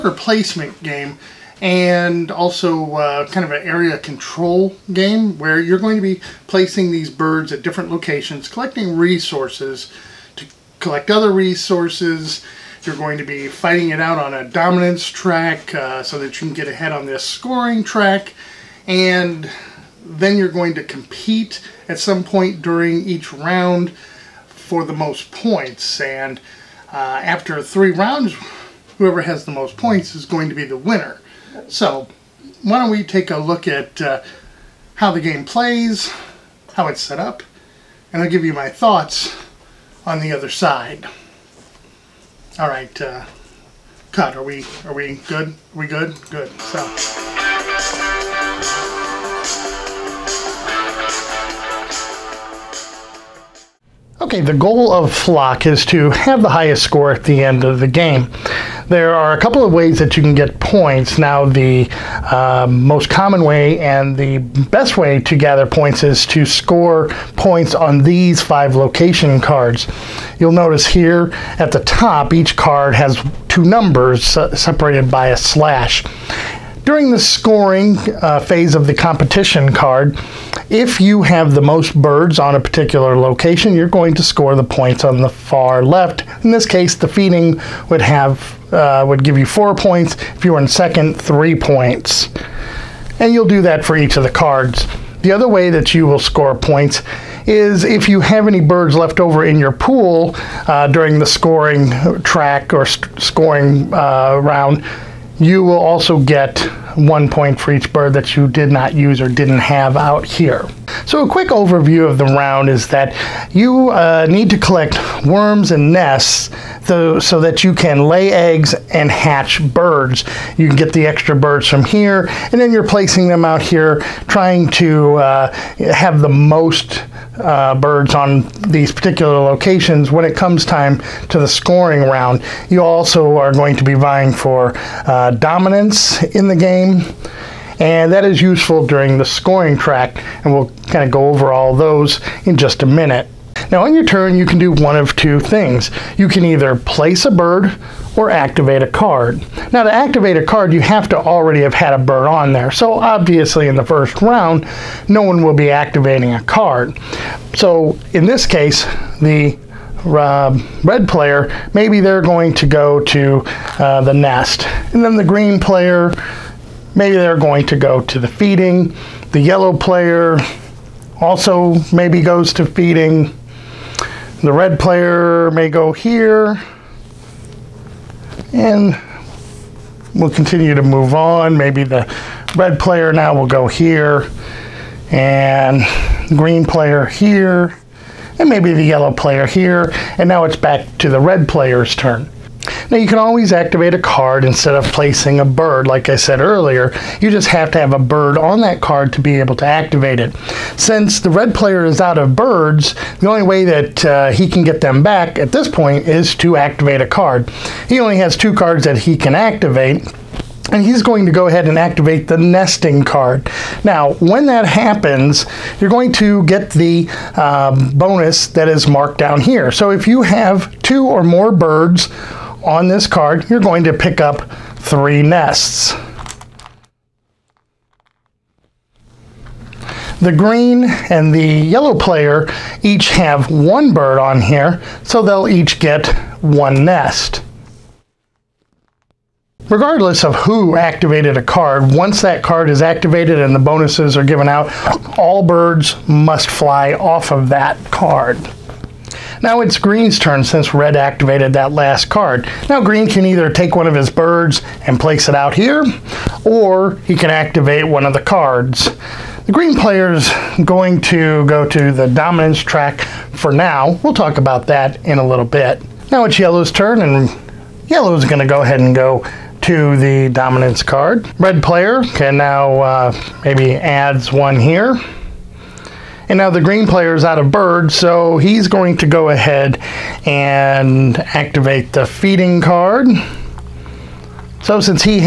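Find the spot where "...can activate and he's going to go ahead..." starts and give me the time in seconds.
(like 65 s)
209 s.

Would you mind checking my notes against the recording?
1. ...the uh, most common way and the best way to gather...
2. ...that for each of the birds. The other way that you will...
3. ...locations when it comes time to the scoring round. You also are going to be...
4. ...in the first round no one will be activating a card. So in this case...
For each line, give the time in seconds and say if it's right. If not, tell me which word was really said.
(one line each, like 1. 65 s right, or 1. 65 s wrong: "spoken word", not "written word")
1. 61 s right
2. 93 s wrong: "cards", not "birds"
3. 129 s right
4. 153 s right.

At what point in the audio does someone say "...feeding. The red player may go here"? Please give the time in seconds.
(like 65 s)
172 s.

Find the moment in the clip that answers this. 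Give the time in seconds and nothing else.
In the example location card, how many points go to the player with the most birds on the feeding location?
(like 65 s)
89 s.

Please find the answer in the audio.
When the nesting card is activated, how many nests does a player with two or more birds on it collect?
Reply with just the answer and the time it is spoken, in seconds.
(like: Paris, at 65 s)
3, at 224 s.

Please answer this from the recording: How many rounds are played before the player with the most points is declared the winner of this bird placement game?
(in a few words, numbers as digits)
3.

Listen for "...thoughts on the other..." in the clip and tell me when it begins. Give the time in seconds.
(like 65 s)
38 s.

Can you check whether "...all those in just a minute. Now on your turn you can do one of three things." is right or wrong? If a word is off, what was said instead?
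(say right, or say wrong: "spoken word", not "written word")
wrong: "two", not "three".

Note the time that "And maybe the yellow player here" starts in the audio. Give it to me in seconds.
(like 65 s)
188 s.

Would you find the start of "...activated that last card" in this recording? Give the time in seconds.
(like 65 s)
250 s.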